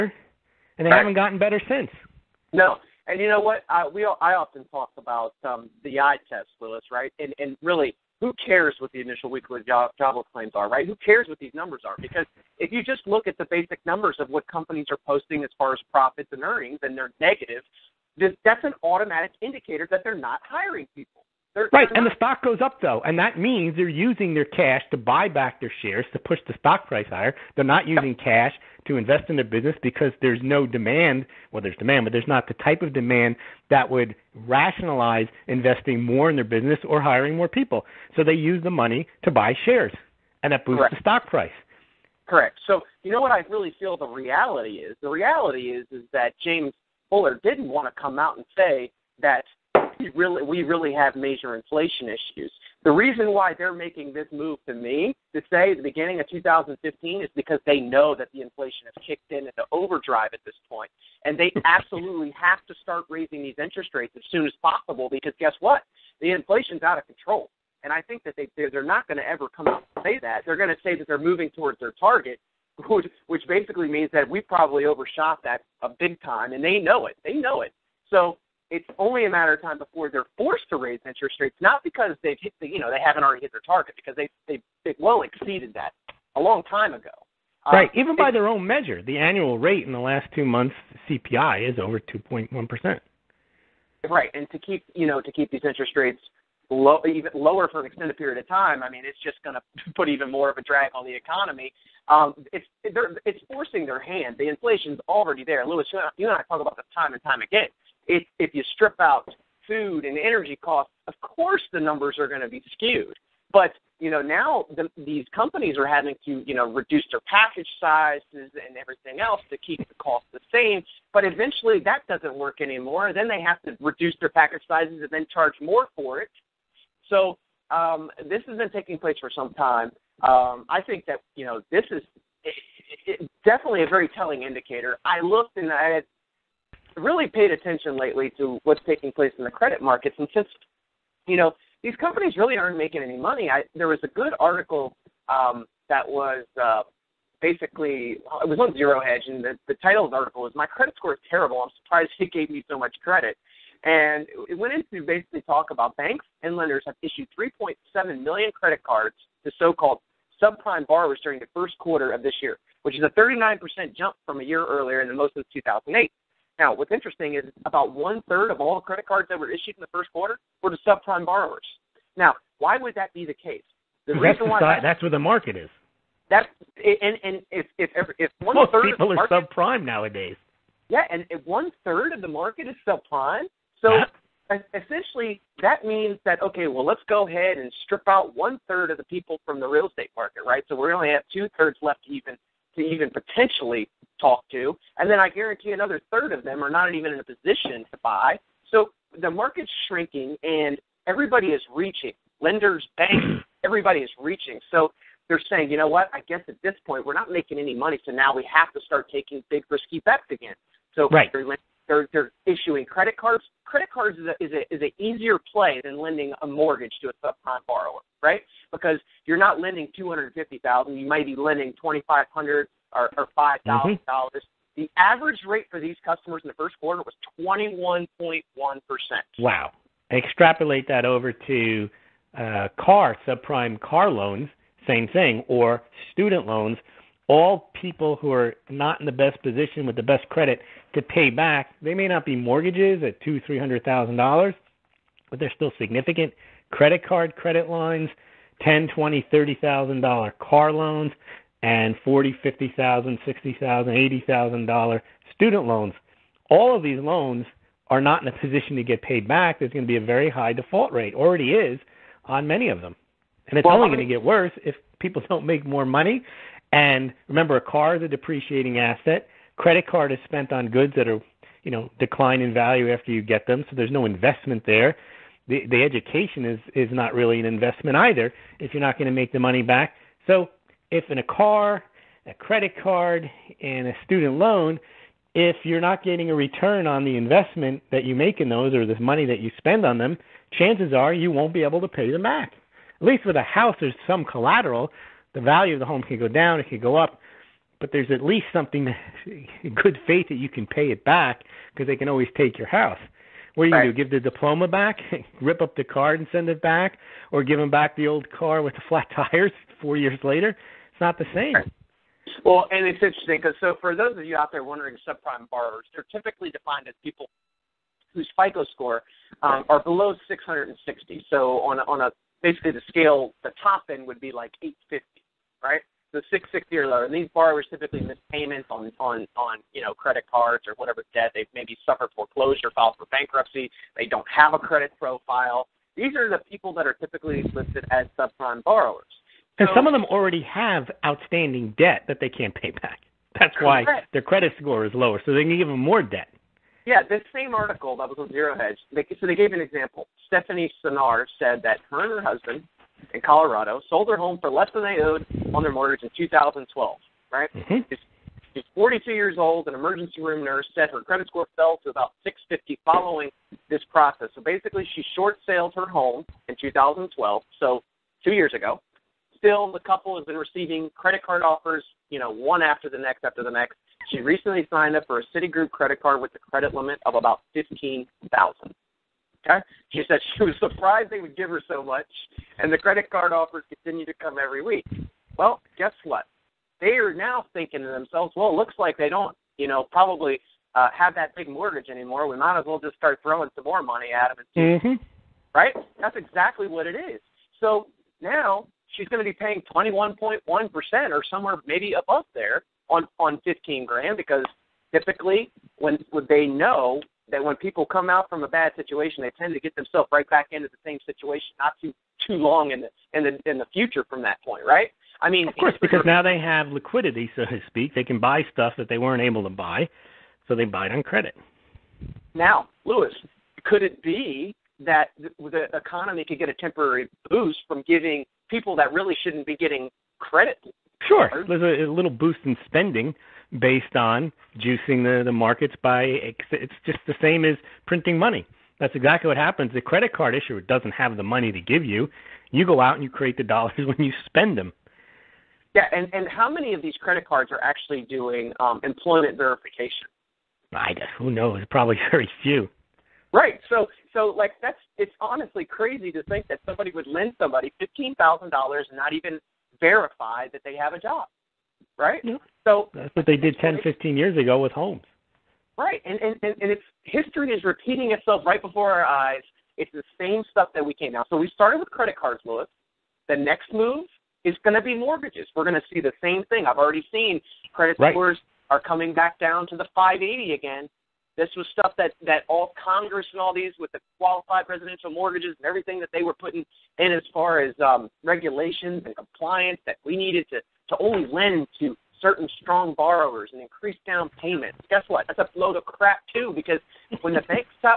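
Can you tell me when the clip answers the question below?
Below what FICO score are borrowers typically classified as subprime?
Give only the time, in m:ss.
5:20.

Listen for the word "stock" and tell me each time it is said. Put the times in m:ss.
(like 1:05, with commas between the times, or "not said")
0:22, 0:26, 0:40.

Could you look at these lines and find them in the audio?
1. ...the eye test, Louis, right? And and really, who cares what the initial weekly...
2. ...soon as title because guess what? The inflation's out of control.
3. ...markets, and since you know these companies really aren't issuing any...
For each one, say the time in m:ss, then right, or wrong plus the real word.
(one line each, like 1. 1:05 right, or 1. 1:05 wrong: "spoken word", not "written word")
1. 0:05 right
2. 1:04 wrong: "possible", not "title"
3. 2:19 wrong: "making", not "issuing".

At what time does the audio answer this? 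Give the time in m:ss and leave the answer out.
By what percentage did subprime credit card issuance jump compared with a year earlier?
2:43.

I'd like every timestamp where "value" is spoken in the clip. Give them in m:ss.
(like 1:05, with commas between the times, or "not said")
4:32, 4:55.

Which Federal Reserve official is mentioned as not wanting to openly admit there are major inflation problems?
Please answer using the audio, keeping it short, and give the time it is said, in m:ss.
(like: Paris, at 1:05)
James Bullard, at 0:46.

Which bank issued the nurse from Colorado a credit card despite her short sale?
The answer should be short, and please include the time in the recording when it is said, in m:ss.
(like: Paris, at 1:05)
Citigroup, at 6:15.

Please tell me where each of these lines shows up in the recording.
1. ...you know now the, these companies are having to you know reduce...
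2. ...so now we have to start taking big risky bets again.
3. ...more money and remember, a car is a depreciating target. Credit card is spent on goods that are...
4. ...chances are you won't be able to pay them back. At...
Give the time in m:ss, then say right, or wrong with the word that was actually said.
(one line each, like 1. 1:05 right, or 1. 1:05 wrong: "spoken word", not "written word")
1. 1:53 right
2. 3:28 right
3. 4:25 wrong: "asset", not "target"
4. 4:50 right.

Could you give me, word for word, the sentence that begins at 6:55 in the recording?
I mean, of course, because now they have liquidity, so to speak.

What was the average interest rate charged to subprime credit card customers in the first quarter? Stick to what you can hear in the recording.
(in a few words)
21.1%.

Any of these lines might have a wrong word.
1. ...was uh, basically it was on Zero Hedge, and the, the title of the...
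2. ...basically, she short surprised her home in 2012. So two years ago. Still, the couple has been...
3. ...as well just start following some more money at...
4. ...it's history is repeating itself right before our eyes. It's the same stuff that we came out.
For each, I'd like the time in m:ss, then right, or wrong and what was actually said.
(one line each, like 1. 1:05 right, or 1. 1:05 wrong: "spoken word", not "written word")
1. 2:26 right
2. 6:04 wrong: "sailed", not "surprised"
3. 6:32 wrong: "throwing", not "following"
4. 7:46 right.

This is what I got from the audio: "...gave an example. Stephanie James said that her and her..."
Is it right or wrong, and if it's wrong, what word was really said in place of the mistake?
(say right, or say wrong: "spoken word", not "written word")
wrong: "Sinar", not "James".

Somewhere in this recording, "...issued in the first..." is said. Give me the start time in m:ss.
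2:49.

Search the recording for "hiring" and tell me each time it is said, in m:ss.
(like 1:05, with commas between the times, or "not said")
0:20, 0:36.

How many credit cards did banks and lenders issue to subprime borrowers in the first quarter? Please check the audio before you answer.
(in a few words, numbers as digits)
3.7 million.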